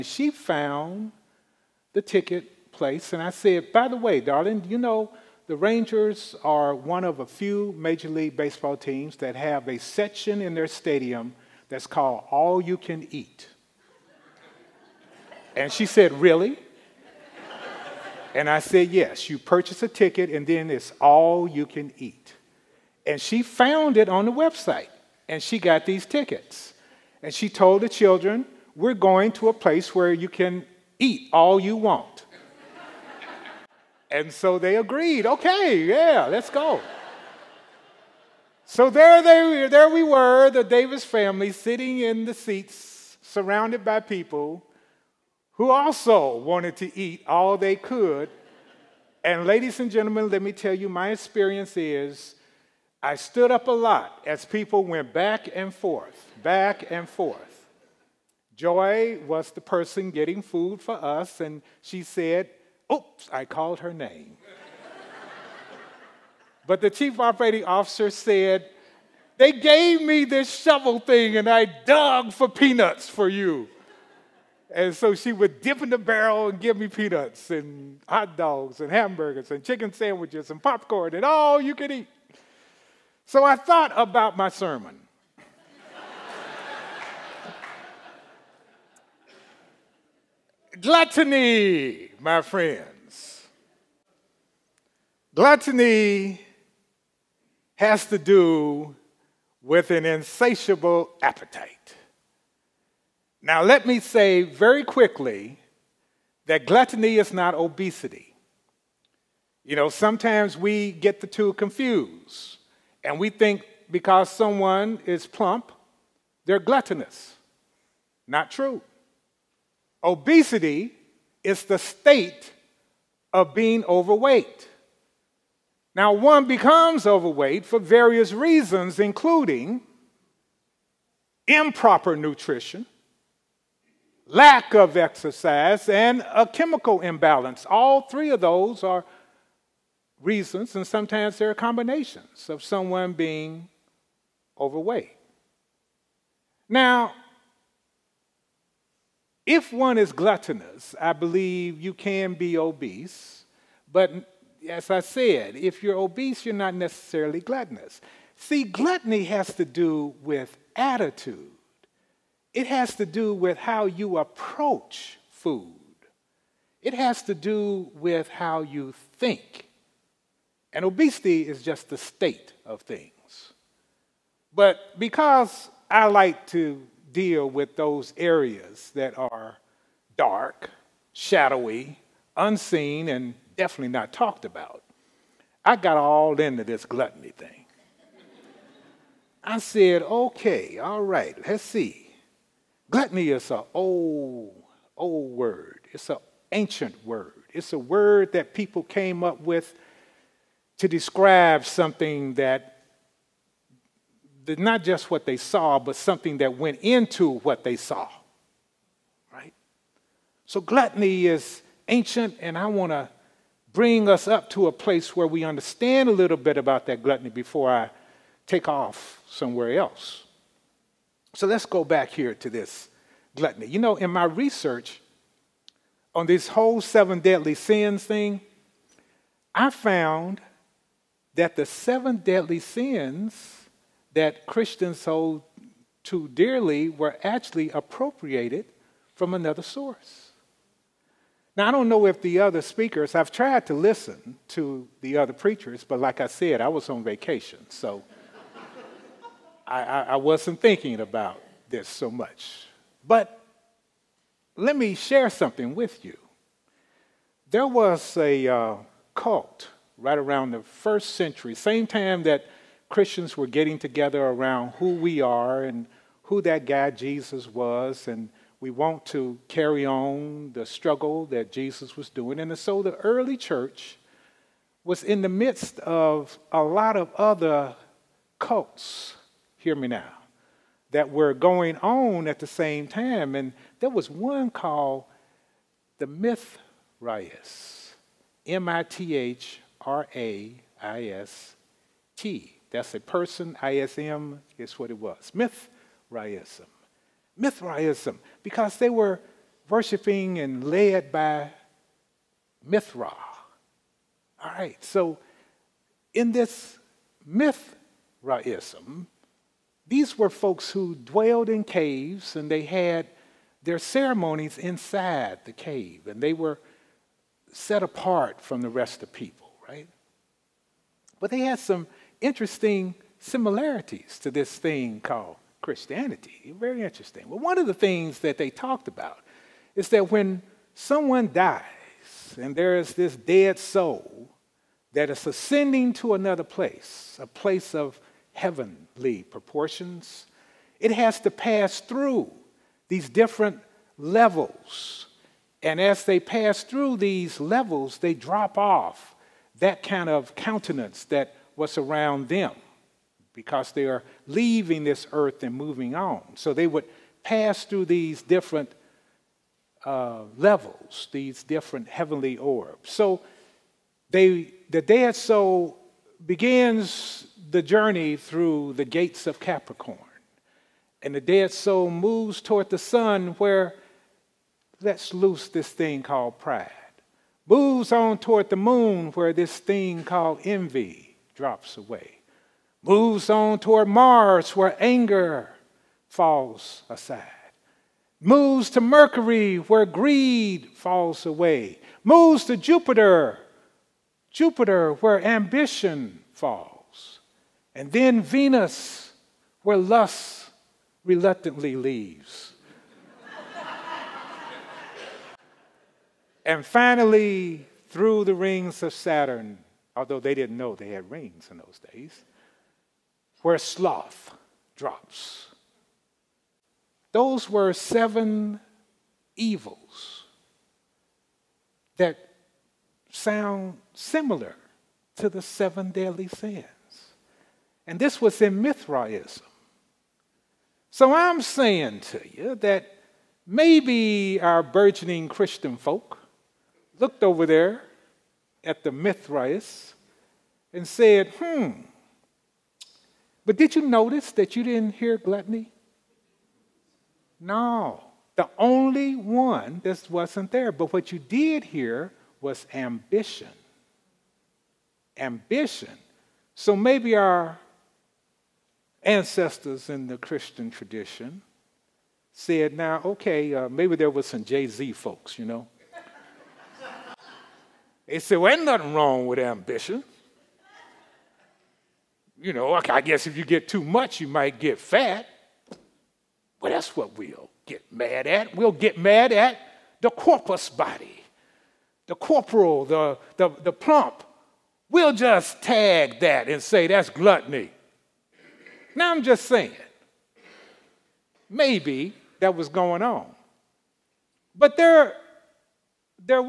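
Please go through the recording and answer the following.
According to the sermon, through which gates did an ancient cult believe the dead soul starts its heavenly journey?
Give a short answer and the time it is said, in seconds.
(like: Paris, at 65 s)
Capricorn, at 369 s.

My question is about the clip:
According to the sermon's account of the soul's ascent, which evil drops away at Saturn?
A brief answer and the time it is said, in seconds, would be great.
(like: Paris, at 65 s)
sloth, at 413 s.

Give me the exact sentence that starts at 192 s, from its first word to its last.
Gluttony is an old, old word.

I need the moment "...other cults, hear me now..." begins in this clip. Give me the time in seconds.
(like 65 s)
277 s.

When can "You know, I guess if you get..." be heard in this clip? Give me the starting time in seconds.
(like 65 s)
472 s.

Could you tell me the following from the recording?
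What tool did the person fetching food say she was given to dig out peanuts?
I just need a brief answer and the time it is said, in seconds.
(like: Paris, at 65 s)
shovel, at 70 s.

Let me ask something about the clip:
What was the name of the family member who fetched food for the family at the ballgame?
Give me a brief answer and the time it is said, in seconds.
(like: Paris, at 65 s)
Joy, at 58 s.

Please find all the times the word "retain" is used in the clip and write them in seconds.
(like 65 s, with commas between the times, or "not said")
not said.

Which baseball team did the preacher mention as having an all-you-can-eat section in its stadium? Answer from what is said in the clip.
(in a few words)
Rangers.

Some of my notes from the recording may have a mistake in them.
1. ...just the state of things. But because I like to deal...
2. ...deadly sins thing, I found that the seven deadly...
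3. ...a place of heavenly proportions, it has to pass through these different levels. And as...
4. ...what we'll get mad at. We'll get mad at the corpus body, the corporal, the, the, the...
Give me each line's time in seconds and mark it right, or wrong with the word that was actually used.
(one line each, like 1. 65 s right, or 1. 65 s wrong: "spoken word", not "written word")
1. 171 s right
2. 227 s right
3. 337 s right
4. 476 s right.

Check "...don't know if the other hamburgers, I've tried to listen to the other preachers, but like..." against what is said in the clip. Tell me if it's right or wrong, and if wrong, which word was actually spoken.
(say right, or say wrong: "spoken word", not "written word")
wrong: "speakers", not "hamburgers".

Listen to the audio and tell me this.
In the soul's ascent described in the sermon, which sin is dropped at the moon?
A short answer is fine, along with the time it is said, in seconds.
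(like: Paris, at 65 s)
envy, at 380 s.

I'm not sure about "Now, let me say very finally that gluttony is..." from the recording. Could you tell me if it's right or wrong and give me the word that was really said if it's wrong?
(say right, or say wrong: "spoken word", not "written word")
wrong: "quickly", not "finally".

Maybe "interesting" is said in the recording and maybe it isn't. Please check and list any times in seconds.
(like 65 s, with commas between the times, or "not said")
322 s, 326 s.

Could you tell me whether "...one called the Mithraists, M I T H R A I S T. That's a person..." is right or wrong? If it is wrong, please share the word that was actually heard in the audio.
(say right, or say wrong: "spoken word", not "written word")
right.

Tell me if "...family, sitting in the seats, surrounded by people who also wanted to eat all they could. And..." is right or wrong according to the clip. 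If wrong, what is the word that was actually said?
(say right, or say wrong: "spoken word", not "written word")
right.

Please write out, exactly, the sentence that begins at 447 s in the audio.
No, the only one that wasn't there.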